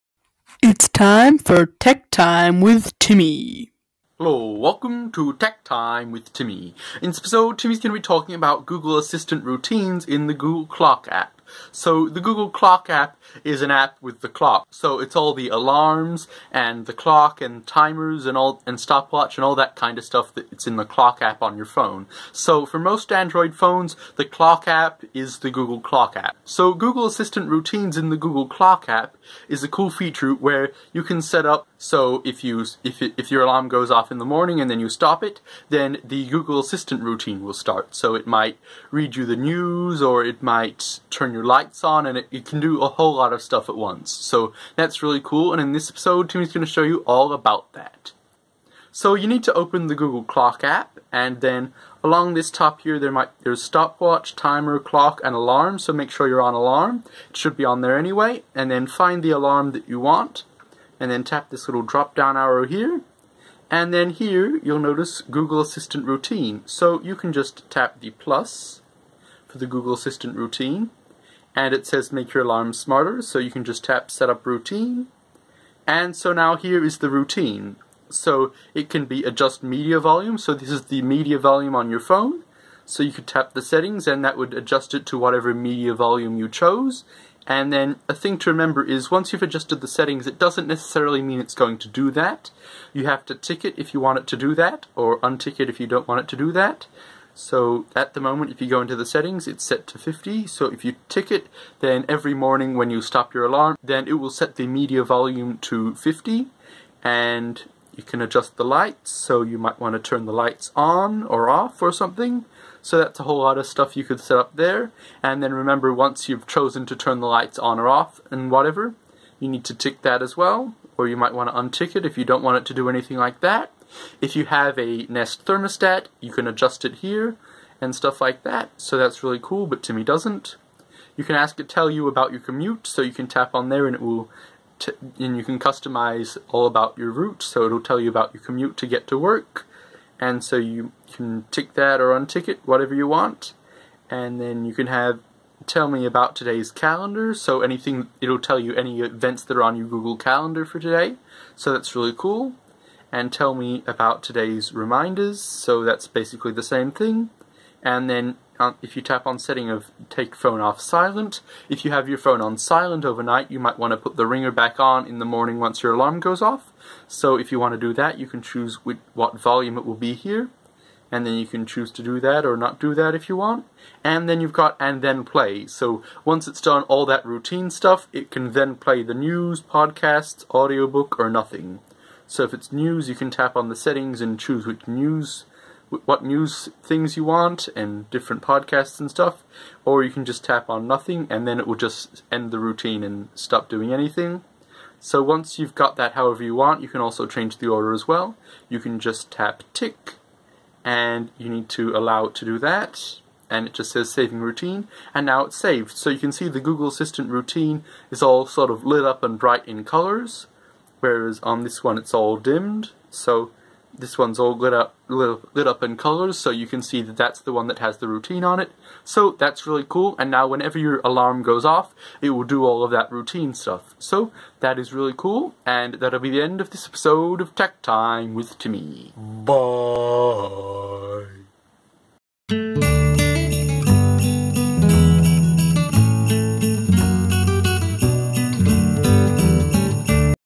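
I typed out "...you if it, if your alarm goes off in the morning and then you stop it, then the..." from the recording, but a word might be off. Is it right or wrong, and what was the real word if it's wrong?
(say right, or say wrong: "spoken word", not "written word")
right.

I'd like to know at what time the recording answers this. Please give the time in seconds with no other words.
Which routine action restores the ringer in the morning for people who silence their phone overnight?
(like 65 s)
160 s.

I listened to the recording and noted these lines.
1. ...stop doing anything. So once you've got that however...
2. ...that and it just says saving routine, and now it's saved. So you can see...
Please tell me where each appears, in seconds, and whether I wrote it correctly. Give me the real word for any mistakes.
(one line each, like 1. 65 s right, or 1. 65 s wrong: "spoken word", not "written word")
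1. 193 s right
2. 202 s right.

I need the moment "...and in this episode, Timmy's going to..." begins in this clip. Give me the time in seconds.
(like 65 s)
45 s.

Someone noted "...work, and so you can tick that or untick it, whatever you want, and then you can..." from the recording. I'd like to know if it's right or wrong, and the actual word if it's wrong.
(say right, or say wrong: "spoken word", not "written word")
right.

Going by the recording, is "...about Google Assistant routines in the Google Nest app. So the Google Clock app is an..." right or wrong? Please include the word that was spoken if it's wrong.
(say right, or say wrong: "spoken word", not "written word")
wrong: "Clock", not "Nest".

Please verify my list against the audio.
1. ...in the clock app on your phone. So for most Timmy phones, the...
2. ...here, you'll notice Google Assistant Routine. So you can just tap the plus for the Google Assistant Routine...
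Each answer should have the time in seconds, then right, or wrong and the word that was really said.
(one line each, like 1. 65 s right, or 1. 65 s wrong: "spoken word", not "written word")
1. 20 s wrong: "Android", not "Timmy"
2. 64 s right.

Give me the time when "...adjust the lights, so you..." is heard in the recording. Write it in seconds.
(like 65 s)
108 s.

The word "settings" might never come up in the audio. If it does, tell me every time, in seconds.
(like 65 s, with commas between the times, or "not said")
83 s, 89 s, 99 s, 159 s, 183 s.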